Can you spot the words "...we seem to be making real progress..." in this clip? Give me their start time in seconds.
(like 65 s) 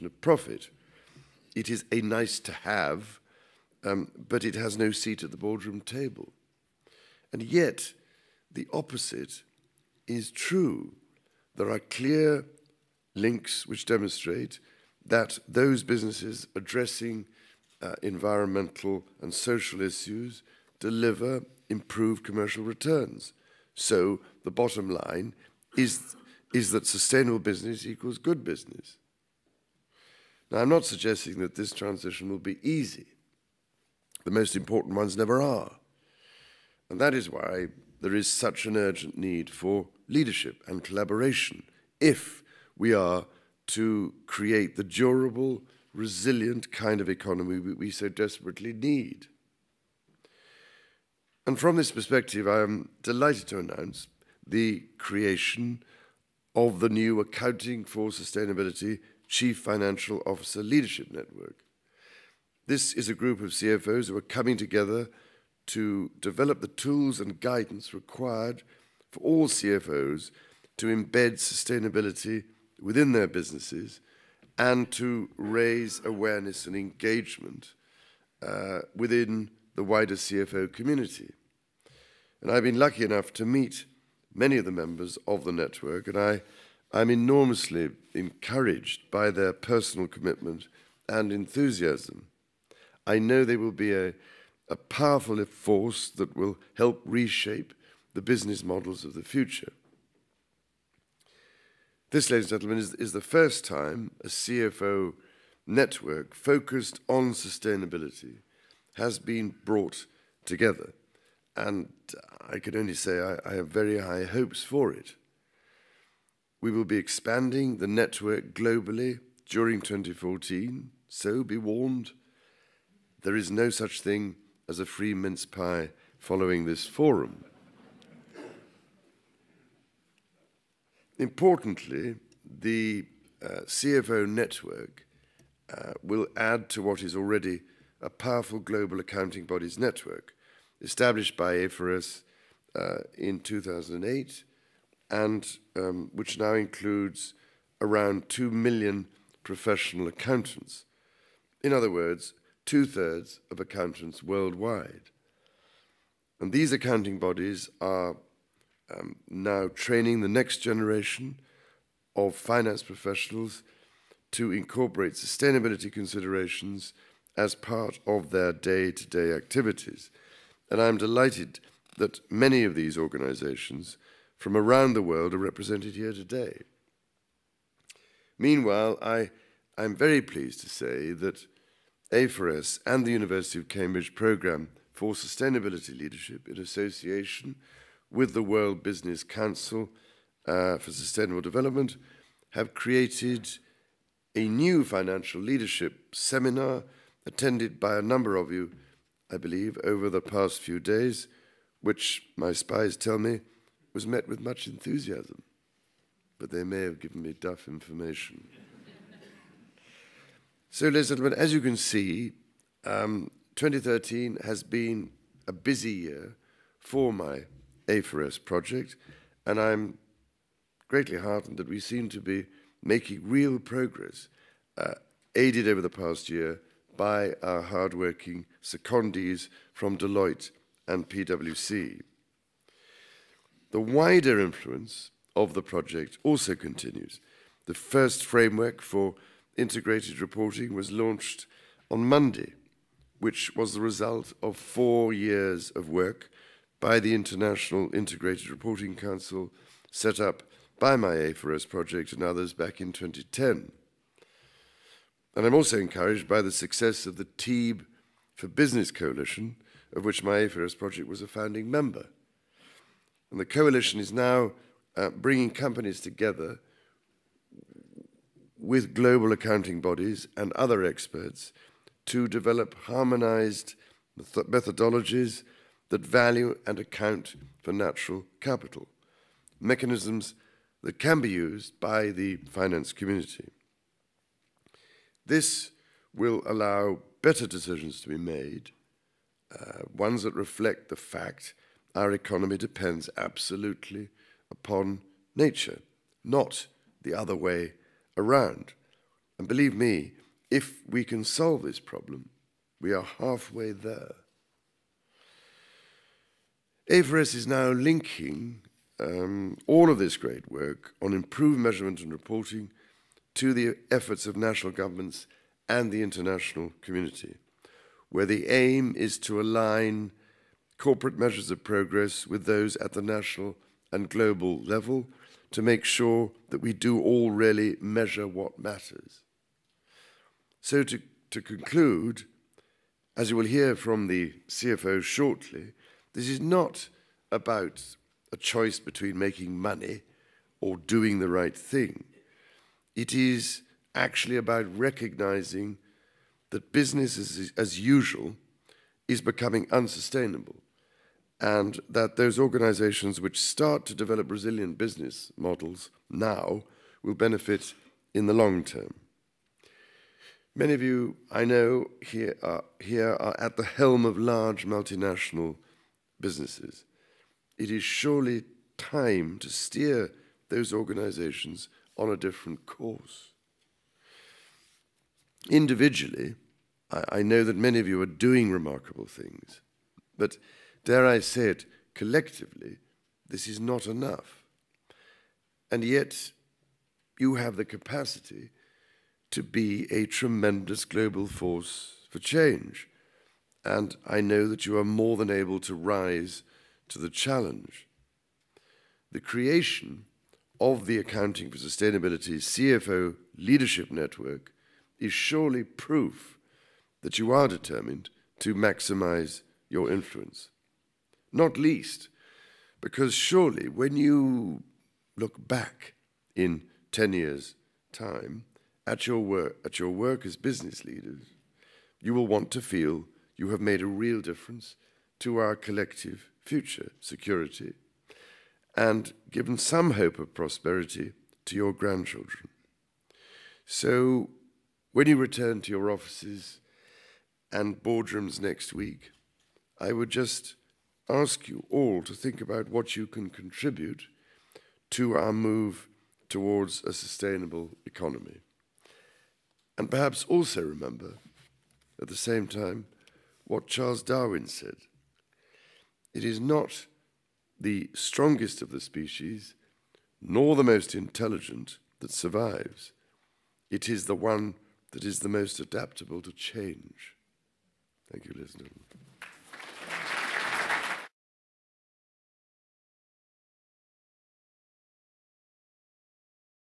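221 s.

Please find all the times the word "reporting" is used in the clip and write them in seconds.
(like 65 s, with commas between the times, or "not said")
240 s, 248 s, 312 s.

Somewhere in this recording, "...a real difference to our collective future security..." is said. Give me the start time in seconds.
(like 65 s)
423 s.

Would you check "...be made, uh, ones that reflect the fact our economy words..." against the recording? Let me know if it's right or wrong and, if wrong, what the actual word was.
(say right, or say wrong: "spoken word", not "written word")
wrong: "depends", not "words".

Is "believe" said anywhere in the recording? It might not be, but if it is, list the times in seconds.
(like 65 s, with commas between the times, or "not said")
199 s, 299 s.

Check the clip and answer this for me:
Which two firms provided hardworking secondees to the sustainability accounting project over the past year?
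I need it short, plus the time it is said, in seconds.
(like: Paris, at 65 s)
Deloitte and PwC, at 229 s.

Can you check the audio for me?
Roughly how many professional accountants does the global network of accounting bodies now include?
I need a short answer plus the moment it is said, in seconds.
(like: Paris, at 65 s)
2 million, at 148 s.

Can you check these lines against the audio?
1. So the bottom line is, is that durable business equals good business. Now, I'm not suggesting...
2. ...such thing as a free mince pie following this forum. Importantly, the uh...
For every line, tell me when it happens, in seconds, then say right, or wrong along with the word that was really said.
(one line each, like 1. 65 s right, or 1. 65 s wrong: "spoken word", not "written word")
1. 23 s wrong: "sustainable", not "durable"
2. 123 s right.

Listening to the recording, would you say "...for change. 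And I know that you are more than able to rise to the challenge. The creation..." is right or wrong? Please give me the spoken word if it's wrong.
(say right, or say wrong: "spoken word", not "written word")
right.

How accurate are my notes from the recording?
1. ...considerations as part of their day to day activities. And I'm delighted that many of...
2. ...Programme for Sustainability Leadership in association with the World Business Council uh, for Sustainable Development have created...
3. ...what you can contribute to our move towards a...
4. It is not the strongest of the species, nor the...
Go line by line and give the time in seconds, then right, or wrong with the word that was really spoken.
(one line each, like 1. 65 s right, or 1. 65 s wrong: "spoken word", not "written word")
1. 165 s right
2. 184 s right
3. 442 s right
4. 456 s right.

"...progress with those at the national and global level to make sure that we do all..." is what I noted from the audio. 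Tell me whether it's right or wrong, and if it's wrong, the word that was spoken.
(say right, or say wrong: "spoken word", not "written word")
right.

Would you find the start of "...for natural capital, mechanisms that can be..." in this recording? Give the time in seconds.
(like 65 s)
277 s.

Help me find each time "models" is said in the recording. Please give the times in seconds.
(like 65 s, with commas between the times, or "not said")
98 s, 355 s.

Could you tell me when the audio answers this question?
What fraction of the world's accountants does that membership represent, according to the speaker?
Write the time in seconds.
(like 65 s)
152 s.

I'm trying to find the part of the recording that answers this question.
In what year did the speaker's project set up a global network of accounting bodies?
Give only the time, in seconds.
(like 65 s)
143 s.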